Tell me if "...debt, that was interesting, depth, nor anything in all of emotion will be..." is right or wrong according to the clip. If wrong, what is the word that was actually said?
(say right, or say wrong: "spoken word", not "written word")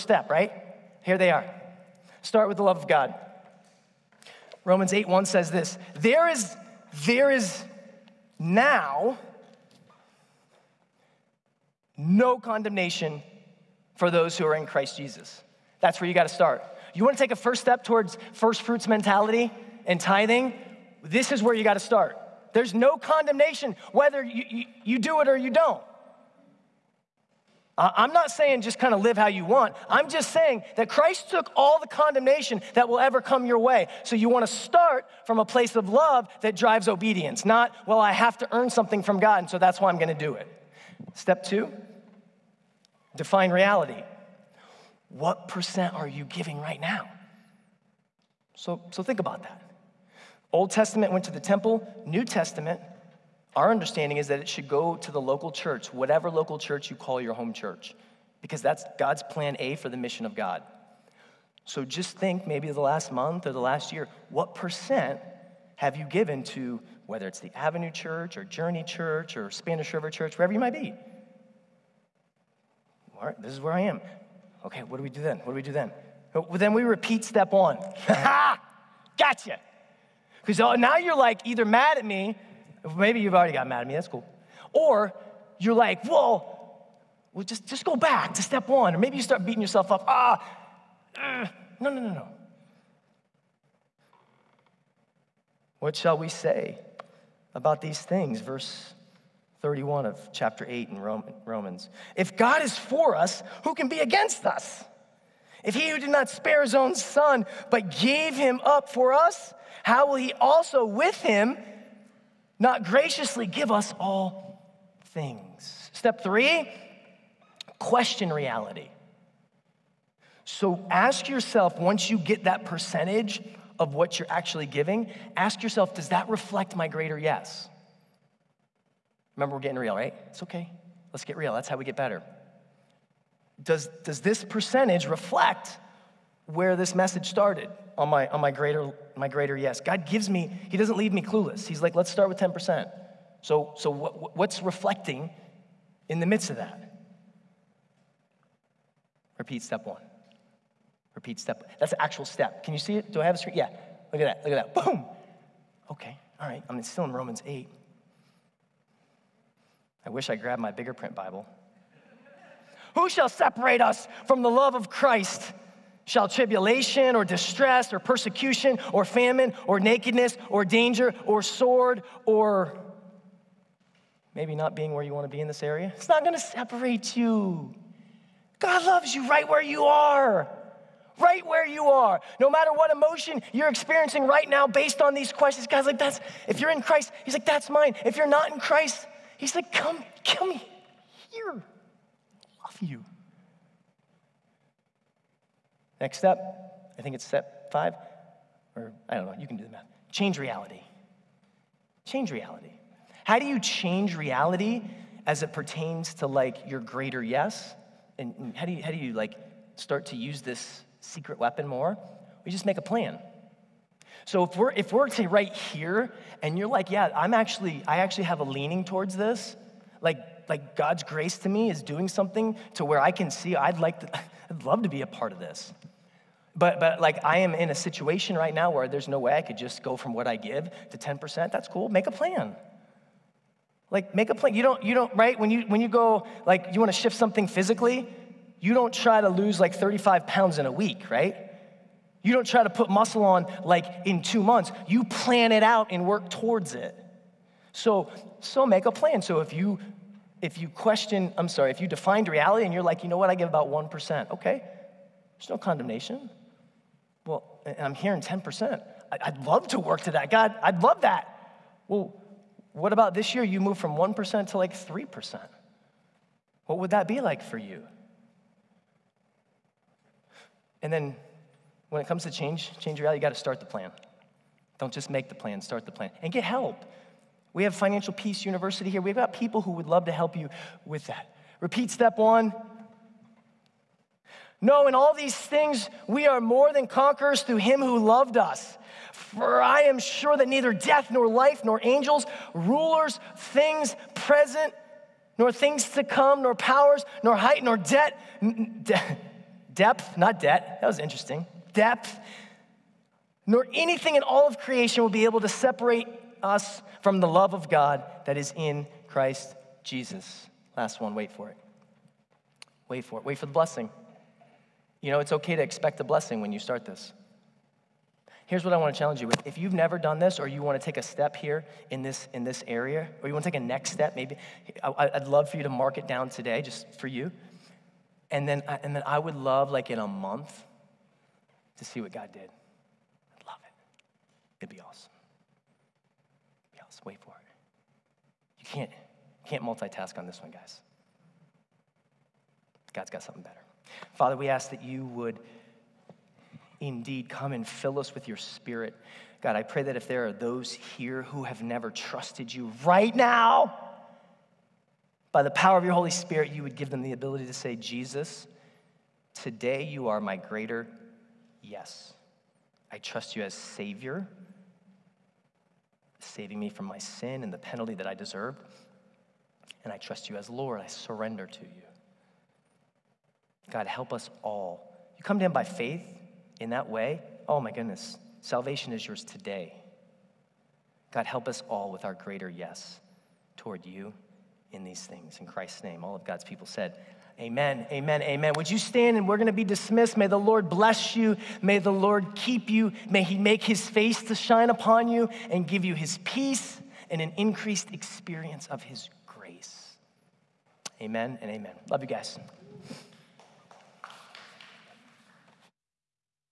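wrong: "creation", not "emotion".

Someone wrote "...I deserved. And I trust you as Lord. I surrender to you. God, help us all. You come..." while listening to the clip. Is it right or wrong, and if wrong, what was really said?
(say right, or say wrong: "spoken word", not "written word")
right.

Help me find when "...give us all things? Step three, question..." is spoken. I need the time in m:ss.
1:53.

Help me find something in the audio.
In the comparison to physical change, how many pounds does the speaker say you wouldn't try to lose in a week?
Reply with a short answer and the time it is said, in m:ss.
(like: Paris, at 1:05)
35, at 3:59.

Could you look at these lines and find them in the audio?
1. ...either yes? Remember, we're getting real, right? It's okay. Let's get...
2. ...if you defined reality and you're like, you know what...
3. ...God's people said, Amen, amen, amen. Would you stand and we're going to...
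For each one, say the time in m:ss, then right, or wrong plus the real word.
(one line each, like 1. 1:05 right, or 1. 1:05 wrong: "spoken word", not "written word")
1. 2:06 wrong: "greater", not "either"
2. 4:11 right
3. 6:26 right.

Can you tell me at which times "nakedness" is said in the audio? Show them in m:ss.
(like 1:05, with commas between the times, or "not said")
2:49.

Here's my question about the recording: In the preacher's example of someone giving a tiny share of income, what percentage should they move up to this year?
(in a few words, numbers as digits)
3%.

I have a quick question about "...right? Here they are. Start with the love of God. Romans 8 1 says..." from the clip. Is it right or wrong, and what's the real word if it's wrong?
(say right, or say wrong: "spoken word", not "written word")
right.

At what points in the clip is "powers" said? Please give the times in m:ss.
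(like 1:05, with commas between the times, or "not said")
4:56, 5:55.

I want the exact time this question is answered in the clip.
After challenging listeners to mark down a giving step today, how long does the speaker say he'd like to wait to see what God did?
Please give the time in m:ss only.
5:29.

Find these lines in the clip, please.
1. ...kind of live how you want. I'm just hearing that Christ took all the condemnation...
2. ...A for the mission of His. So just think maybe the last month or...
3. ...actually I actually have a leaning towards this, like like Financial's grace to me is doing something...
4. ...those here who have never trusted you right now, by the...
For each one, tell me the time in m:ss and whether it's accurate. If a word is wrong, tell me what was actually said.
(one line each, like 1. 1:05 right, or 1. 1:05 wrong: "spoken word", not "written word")
1. 0:28 wrong: "saying", not "hearing"
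2. 0:59 wrong: "God", not "His"
3. 3:37 wrong: "God", not "Financial"
4. 5:50 right.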